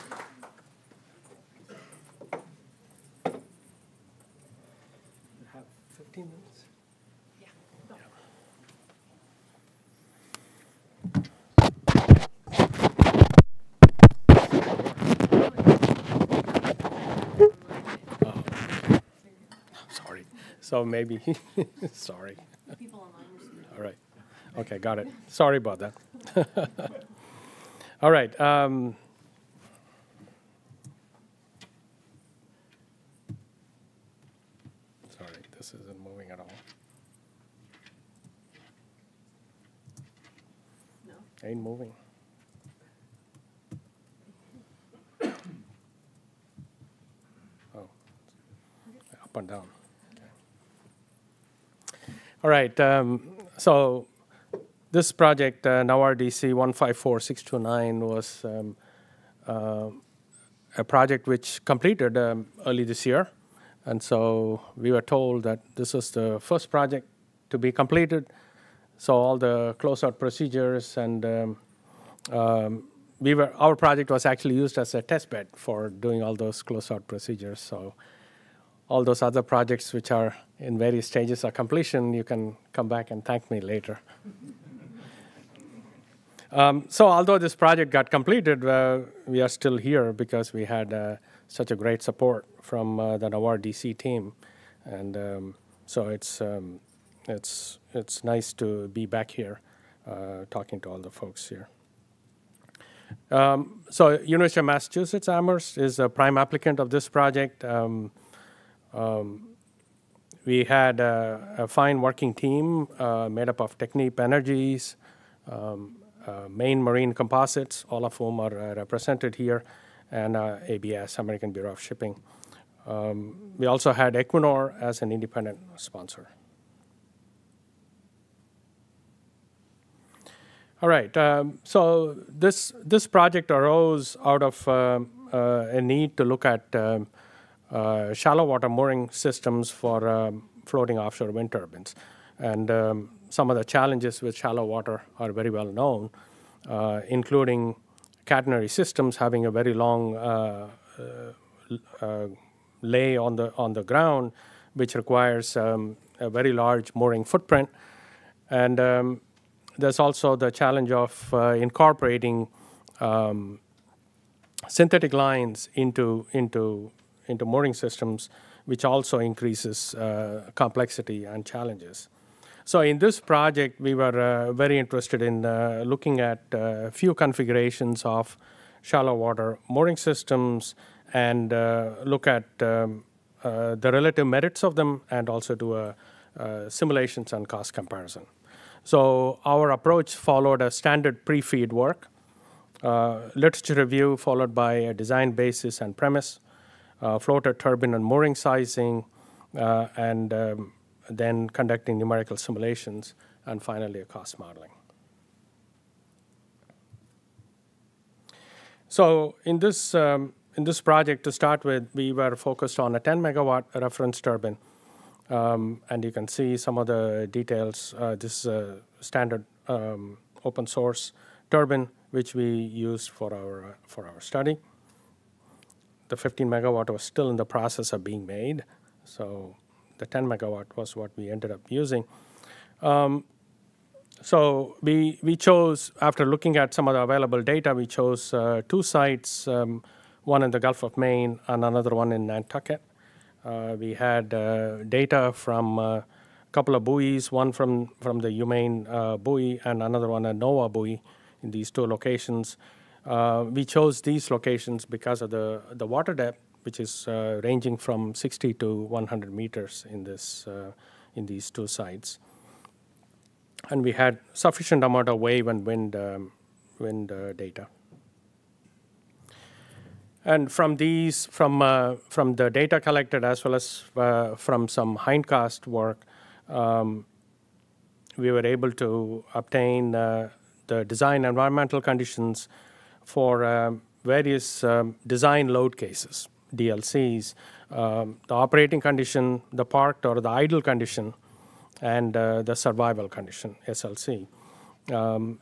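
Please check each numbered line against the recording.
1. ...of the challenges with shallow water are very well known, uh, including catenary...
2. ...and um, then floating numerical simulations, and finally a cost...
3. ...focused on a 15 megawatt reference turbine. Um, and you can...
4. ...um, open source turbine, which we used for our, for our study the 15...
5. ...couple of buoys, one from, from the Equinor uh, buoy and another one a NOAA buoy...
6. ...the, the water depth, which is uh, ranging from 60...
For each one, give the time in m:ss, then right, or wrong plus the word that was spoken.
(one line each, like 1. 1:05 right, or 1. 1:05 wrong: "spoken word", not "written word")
1. 2:23 right
2. 3:19 wrong: "conducting", not "floating"
3. 3:32 wrong: "10", not "15"
4. 3:39 right
5. 4:06 wrong: "UMaine", not "Equinor"
6. 4:15 right.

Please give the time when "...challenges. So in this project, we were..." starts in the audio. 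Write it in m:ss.
2:51.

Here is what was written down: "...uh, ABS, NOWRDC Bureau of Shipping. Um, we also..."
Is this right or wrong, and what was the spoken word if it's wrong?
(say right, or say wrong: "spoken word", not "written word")
wrong: "American", not "NOWRDC".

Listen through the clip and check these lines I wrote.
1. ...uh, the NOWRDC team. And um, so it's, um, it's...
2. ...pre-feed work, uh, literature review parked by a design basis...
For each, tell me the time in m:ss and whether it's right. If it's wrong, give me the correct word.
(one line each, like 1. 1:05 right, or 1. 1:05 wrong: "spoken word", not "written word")
1. 1:32 right
2. 3:11 wrong: "followed", not "parked".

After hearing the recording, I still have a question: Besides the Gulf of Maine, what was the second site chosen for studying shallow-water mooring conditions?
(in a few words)
Nantucket.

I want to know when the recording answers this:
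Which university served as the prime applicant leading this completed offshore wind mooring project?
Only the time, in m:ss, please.
1:44.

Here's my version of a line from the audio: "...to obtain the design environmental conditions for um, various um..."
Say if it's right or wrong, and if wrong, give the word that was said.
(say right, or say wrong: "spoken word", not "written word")
right.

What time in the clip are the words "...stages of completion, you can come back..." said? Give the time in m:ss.
1:21.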